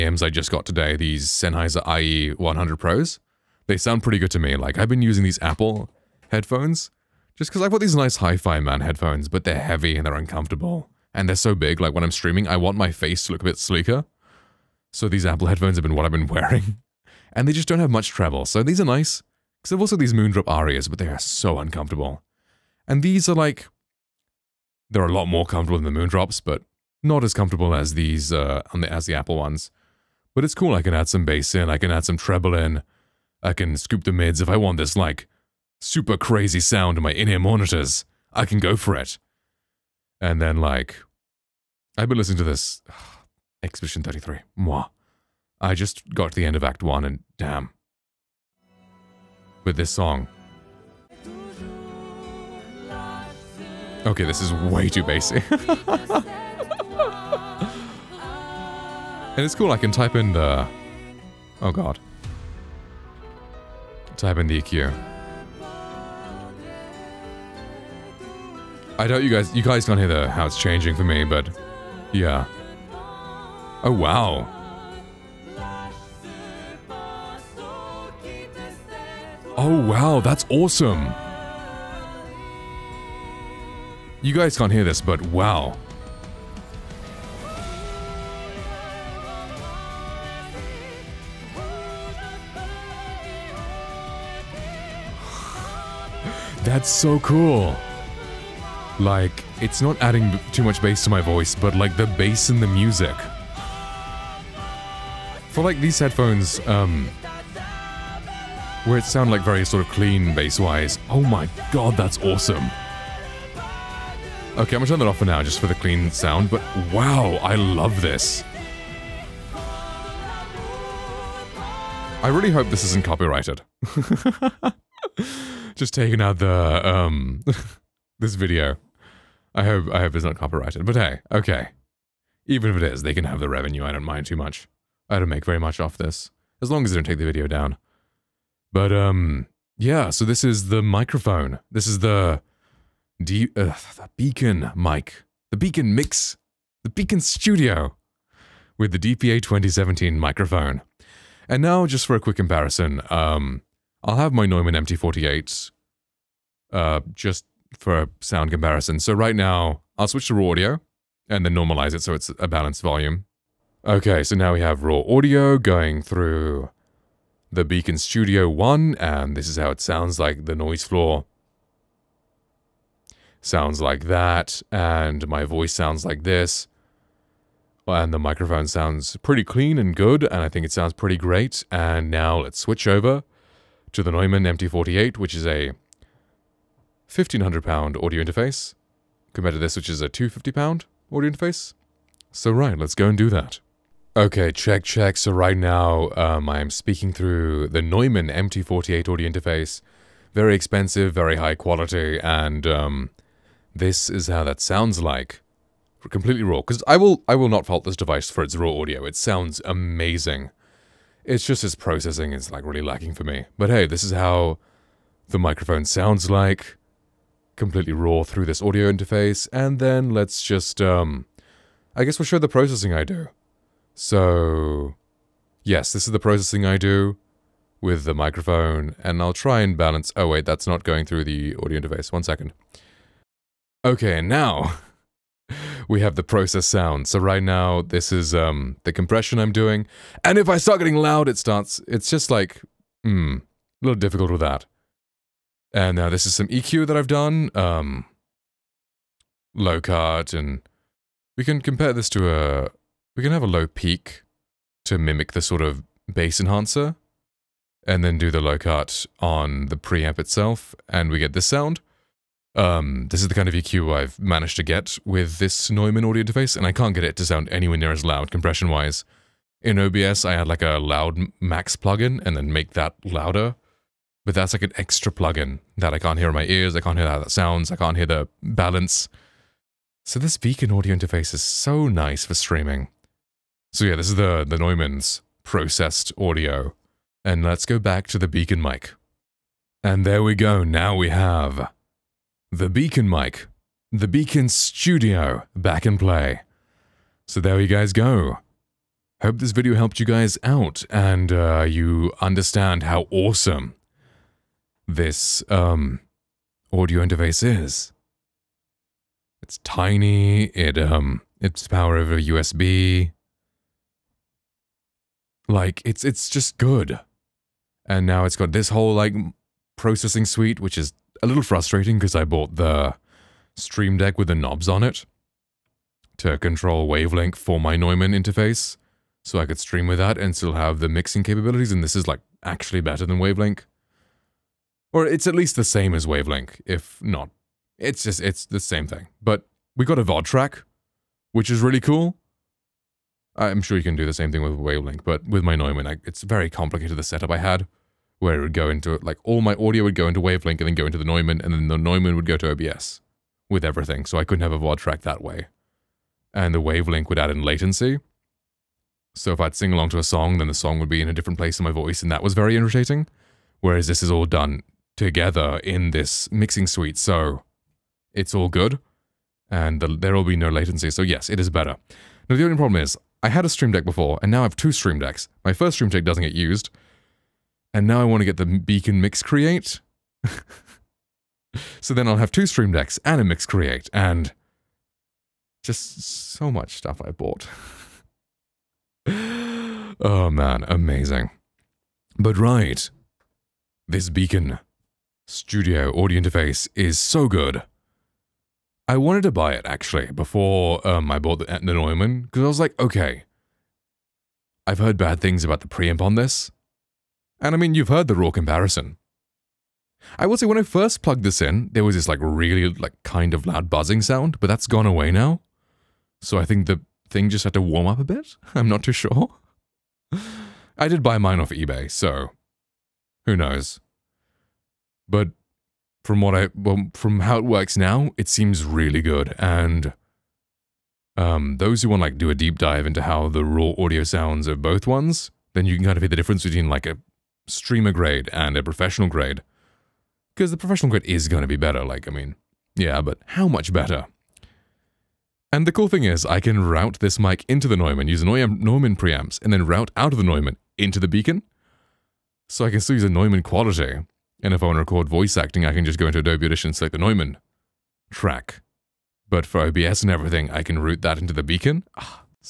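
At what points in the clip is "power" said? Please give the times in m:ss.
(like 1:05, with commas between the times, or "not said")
5:11.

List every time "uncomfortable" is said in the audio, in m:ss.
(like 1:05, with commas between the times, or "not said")
0:10, 0:21.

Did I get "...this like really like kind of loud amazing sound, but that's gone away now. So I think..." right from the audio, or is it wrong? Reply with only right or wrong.
wrong.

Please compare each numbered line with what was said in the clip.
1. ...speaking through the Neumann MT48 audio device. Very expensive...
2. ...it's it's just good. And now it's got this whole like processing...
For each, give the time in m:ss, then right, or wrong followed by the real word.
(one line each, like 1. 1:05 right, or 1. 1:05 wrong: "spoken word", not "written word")
1. 3:16 wrong: "interface", not "device"
2. 5:15 right.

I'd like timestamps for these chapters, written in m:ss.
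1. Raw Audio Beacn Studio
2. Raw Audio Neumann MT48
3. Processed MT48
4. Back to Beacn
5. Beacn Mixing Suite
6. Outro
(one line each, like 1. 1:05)
1. 2:23
2. 3:13
3. 3:53
4. 4:49
5. 5:18
6. 6:32.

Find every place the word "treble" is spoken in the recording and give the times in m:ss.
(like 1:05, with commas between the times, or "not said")
0:18, 0:32.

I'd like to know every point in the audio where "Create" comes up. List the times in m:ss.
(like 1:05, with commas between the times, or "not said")
6:19, 6:23.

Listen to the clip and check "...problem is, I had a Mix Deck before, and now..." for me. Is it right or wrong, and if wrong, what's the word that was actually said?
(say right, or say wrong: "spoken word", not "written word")
wrong: "Stream", not "Mix".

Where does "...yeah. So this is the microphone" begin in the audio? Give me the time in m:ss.
2:19.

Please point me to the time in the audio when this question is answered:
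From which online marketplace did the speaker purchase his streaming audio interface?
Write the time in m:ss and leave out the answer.
7:01.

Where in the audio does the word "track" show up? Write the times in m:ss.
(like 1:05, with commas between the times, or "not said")
5:40, 5:54, 7:38.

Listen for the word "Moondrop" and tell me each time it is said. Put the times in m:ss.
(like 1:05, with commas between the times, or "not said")
0:20, 0:25.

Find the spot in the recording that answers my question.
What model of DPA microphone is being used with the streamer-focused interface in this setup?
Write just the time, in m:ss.
2:28.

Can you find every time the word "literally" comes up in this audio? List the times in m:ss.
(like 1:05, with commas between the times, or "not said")
not said.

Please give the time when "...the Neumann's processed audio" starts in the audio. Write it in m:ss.
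4:44.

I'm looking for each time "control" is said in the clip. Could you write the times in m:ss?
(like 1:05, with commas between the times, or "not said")
5:26.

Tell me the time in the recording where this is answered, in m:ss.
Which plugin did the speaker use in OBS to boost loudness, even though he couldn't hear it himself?
4:30.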